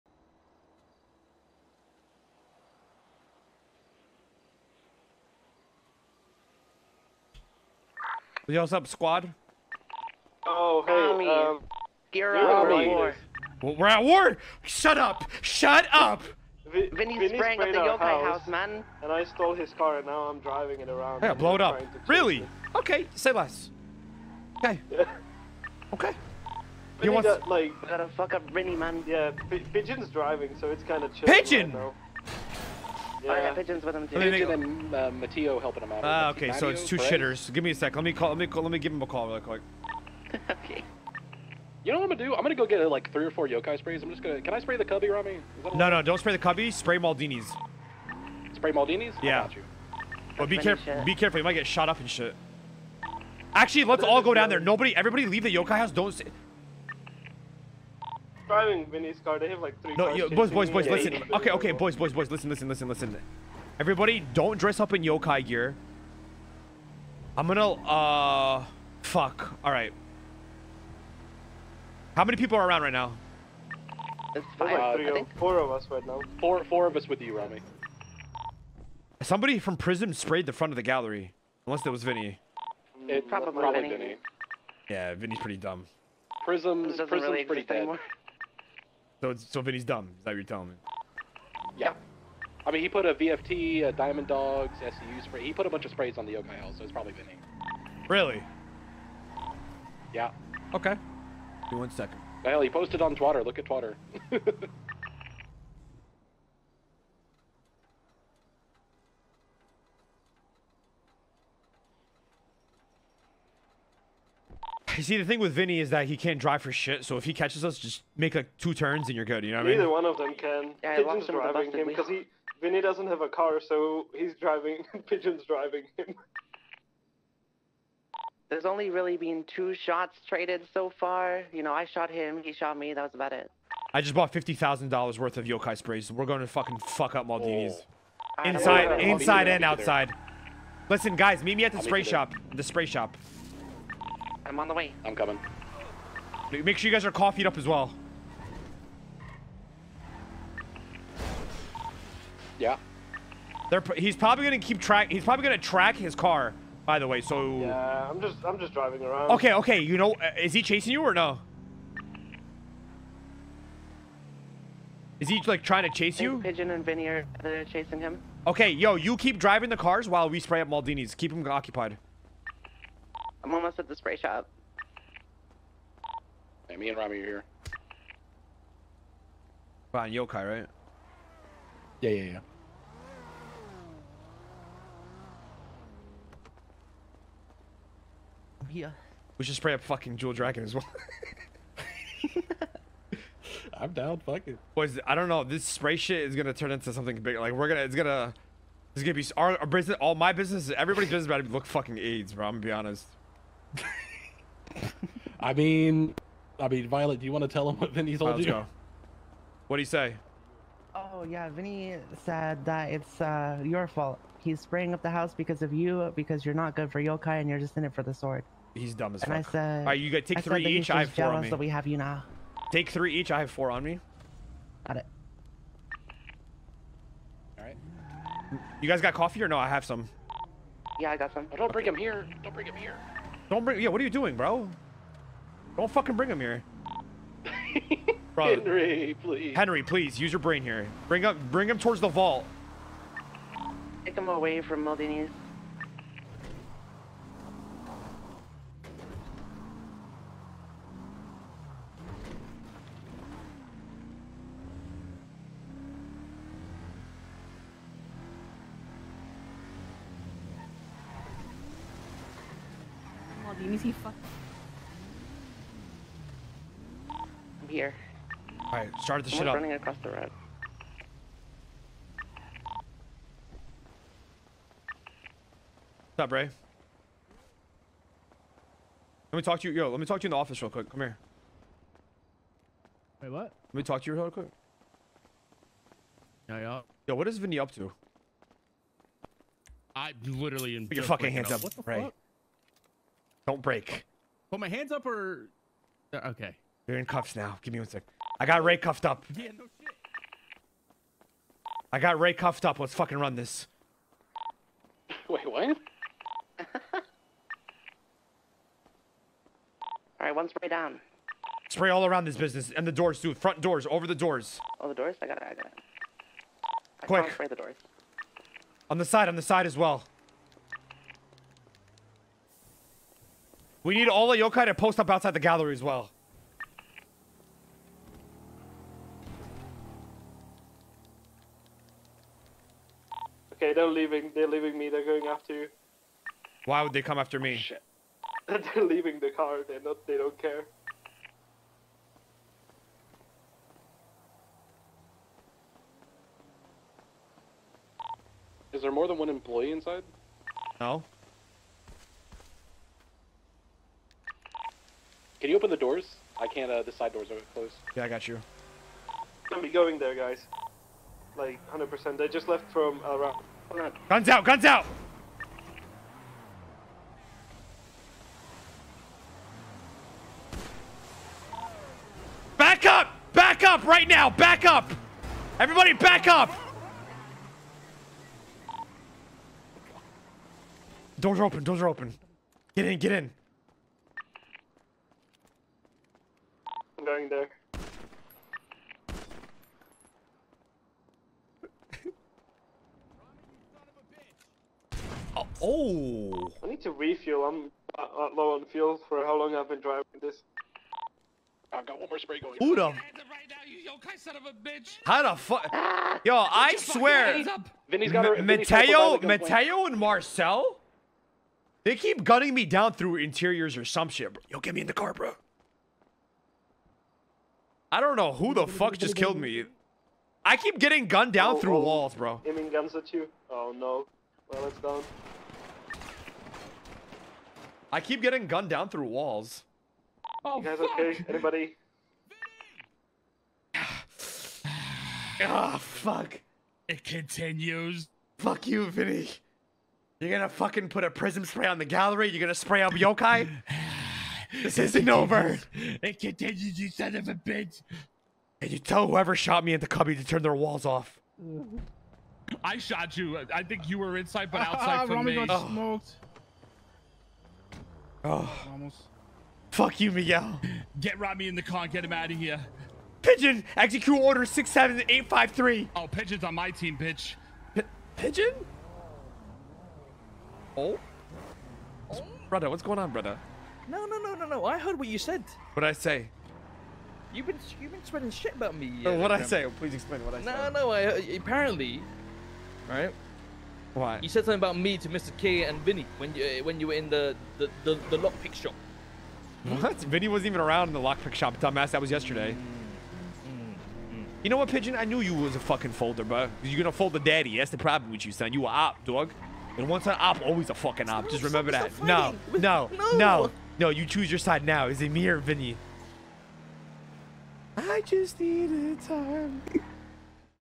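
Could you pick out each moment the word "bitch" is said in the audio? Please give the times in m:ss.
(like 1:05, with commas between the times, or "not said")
7:27, 7:46.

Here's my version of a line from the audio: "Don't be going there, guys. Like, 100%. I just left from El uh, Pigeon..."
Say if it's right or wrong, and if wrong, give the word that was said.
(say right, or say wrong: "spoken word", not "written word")
wrong: "Guns", not "Pigeon".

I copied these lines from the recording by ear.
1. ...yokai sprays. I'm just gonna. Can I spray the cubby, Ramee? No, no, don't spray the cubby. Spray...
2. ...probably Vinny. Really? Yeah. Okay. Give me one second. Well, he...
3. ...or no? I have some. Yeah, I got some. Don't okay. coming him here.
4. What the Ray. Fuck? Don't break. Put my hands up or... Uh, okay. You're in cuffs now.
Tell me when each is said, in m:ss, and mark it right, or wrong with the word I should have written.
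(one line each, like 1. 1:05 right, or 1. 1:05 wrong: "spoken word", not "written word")
1. 0:43 right
2. 1:36 right
3. 3:49 wrong: "bring", not "coming"
4. 4:51 right.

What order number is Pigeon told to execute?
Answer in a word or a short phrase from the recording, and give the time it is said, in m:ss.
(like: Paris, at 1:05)
67853, at 7:44.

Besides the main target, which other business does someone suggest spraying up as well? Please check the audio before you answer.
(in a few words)
Jewel Dragon.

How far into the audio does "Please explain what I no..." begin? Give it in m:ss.
7:59.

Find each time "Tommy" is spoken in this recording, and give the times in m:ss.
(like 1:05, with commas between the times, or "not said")
0:10.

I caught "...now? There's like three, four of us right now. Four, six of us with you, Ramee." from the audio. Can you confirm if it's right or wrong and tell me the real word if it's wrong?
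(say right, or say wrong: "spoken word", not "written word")
wrong: "four", not "six".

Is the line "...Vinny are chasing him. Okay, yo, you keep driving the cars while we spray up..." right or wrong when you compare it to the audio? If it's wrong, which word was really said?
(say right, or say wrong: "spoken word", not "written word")
right.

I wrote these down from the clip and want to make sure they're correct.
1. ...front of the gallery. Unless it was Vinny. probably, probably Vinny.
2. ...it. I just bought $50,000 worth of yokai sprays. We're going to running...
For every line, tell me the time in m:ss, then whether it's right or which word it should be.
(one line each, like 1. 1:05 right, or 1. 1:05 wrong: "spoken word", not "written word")
1. 1:20 right
2. 2:13 wrong: "fucking", not "running".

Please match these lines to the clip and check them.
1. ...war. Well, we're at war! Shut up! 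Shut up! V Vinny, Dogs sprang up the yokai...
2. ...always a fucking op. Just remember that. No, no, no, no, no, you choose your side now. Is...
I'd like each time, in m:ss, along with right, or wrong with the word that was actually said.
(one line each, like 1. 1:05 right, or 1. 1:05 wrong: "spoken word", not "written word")
1. 0:12 wrong: "Vinny", not "Dogs"
2. 8:20 right.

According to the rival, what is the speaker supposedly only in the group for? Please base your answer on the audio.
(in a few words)
the sword.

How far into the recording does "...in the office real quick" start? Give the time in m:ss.
4:40.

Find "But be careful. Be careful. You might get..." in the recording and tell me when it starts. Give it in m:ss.
0:50.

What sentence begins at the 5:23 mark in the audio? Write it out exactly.
We need all the yokai to post up outside the gallery as well.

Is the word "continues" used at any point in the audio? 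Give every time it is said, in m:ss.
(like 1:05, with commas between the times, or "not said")
7:17, 7:26.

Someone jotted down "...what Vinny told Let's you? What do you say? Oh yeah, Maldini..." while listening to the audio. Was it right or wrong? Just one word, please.
wrong.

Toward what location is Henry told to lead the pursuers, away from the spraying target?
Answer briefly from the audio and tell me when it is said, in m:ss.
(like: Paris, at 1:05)
the vault, at 4:01.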